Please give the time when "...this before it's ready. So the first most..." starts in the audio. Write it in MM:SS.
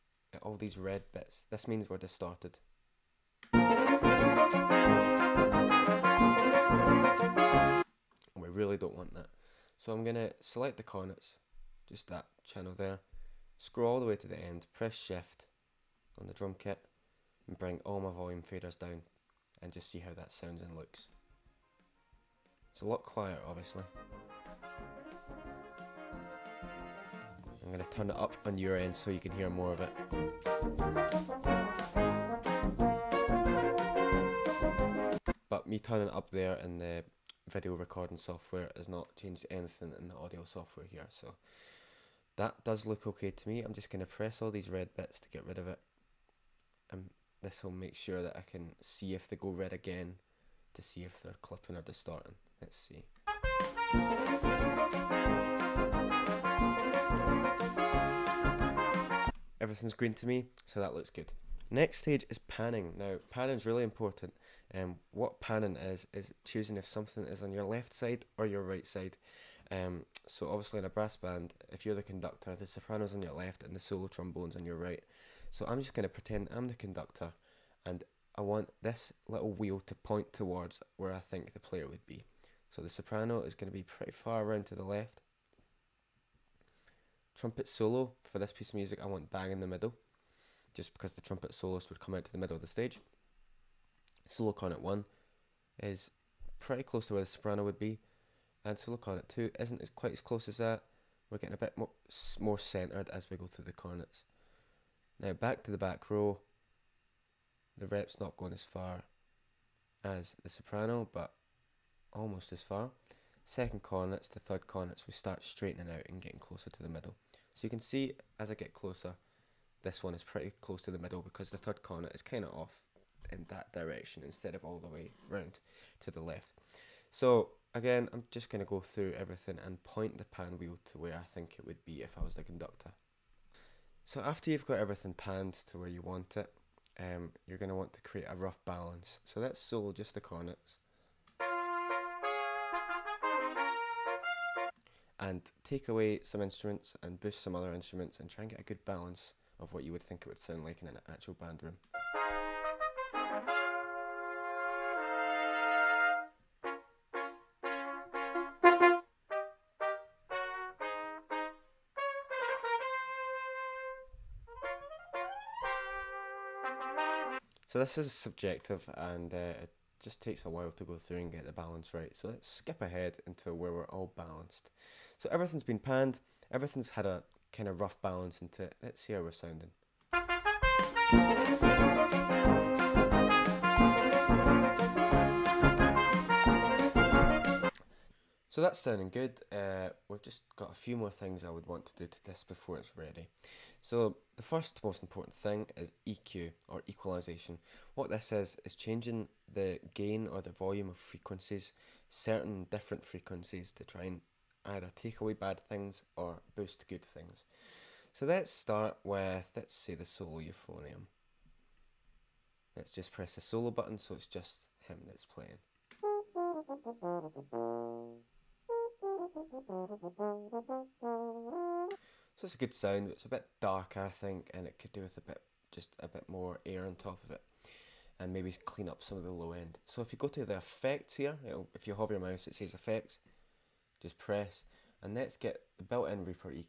03:12.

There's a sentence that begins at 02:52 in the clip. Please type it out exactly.
So let's skip ahead until where we're all balanced.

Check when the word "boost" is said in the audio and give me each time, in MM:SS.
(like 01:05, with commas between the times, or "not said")
02:27, 03:26.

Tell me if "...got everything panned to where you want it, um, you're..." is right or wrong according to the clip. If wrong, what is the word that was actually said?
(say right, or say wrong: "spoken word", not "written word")
right.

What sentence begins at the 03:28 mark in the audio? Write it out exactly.
So let's start with, let's say the solo euphonium.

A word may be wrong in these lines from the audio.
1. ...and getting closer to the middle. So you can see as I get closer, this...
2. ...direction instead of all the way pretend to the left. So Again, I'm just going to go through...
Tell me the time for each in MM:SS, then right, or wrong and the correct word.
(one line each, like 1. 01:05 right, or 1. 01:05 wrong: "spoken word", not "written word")
1. 01:56 right
2. 02:03 wrong: "round", not "pretend".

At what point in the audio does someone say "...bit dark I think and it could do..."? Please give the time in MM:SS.
03:43.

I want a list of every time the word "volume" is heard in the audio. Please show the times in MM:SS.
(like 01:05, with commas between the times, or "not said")
00:18, 03:20.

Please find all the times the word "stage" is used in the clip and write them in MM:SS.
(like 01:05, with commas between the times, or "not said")
01:01, 01:32.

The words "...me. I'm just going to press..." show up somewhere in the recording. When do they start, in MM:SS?
00:43.